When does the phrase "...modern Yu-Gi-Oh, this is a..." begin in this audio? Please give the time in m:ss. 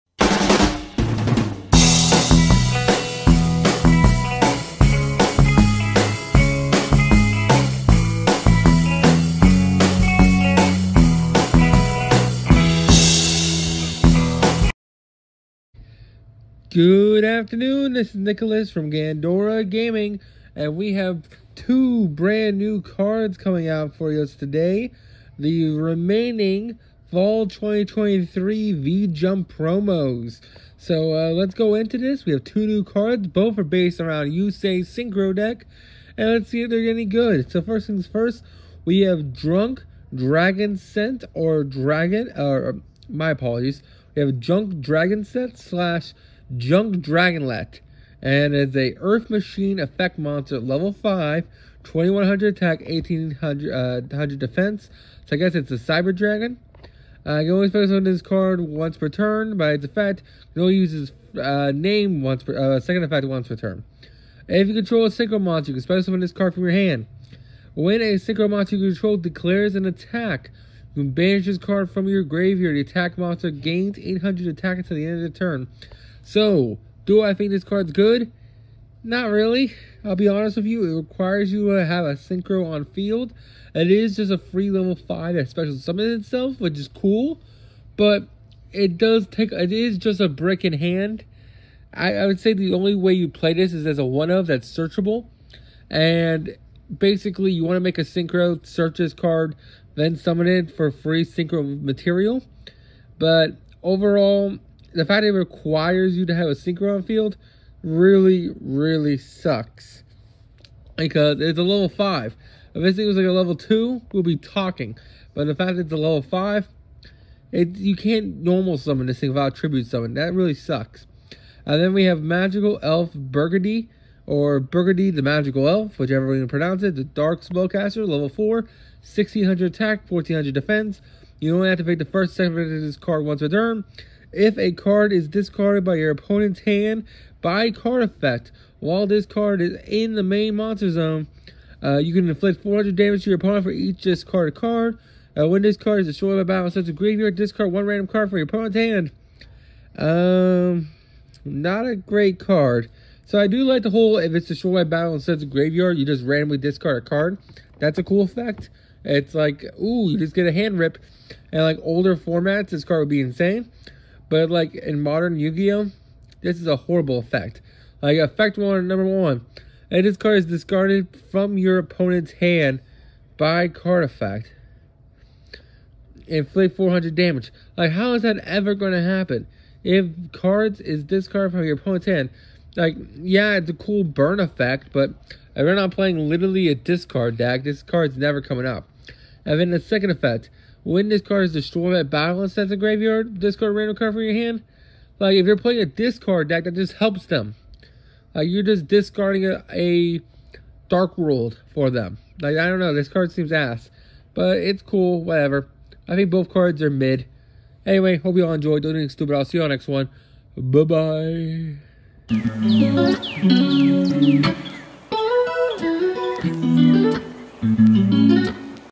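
2:45.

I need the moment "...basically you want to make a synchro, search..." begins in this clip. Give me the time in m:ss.
1:36.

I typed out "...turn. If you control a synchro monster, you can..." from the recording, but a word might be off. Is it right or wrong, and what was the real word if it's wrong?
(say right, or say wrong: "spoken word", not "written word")
right.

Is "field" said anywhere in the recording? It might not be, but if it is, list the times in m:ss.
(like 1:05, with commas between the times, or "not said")
1:22, 1:47.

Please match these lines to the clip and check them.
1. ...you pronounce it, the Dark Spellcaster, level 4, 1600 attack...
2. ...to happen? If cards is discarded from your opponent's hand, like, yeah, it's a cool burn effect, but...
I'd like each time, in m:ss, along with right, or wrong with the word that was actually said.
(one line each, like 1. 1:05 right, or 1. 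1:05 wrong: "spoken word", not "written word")
1. 2:06 right
2. 2:58 right.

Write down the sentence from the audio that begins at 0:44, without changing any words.
We have Junk Dragon Scent slash Junk Dragonlet, and it's a Earth Machine effect monster, level 5, 2100 attack, 1800 uh, defense.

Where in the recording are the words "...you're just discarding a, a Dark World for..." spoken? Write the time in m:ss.
3:18.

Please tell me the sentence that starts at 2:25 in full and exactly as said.
Uh, when this card is destroyed by battle, such a graveyard, discard one random card from your opponent's hand.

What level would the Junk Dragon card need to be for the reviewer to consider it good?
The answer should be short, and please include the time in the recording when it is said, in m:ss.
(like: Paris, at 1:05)
2, at 1:53.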